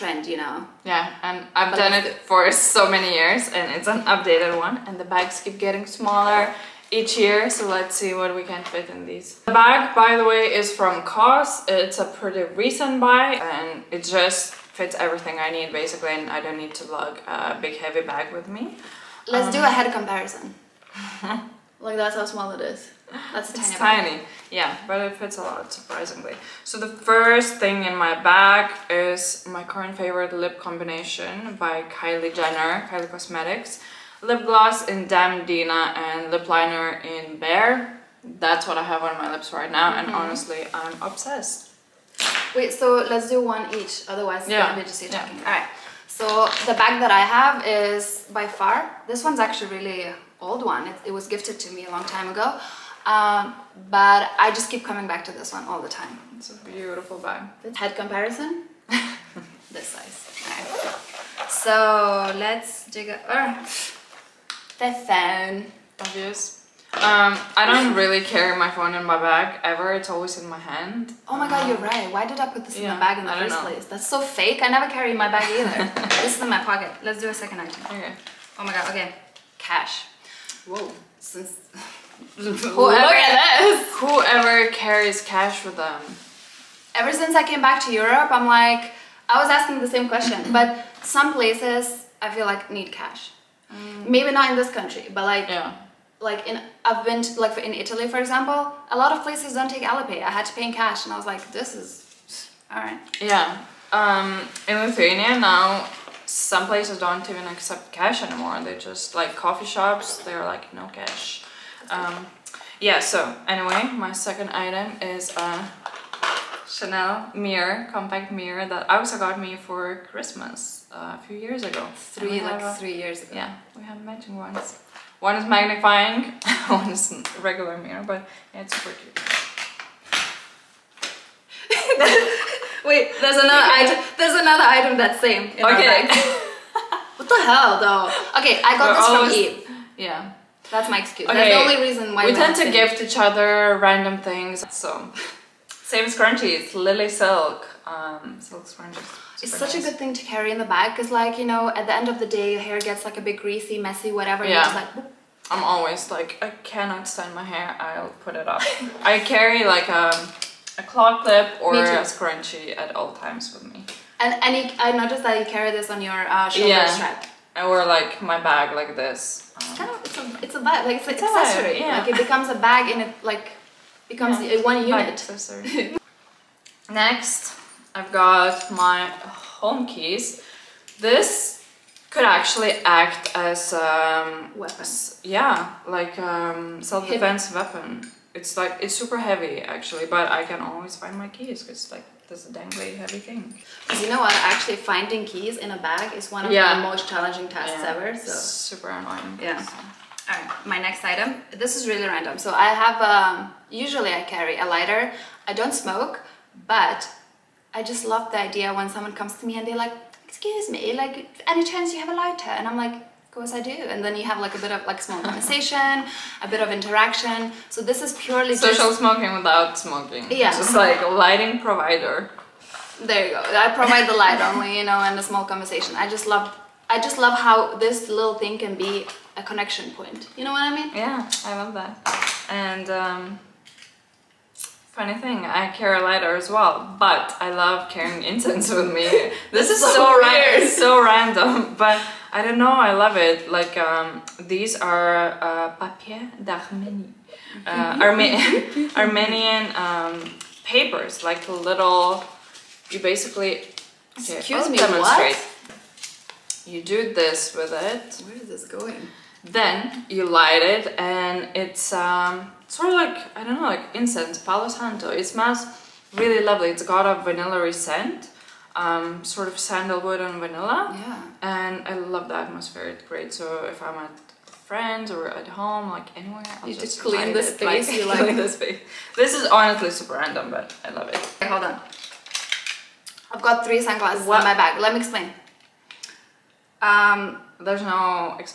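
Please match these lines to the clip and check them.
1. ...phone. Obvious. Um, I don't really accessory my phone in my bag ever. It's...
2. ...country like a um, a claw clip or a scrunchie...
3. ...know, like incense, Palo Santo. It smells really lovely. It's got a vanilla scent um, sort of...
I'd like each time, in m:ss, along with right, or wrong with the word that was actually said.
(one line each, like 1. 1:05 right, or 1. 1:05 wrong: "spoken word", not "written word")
1. 1:04 wrong: "carry", not "accessory"
2. 2:39 wrong: "carry", not "country"
3. 4:23 right.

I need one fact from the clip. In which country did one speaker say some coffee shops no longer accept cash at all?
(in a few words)
Lithuania.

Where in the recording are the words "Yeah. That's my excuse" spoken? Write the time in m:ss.
2:19.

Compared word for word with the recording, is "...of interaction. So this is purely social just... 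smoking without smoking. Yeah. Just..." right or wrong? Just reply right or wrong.
right.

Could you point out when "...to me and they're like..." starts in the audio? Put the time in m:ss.
3:29.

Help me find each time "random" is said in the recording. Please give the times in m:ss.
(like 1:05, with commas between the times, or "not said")
2:23, 3:22, 4:01, 4:40.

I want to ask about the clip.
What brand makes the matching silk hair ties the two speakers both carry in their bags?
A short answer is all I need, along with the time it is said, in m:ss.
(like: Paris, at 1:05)
Lilysilk, at 2:26.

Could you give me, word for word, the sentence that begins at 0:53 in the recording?
Um, but I just keep coming back to this one all the time.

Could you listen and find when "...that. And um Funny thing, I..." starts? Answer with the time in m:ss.
3:51.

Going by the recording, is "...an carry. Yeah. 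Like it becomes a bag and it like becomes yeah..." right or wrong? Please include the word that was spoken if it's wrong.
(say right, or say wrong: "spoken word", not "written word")
wrong: "accessory", not "carry".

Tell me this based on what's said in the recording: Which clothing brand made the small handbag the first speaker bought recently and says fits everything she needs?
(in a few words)
COS.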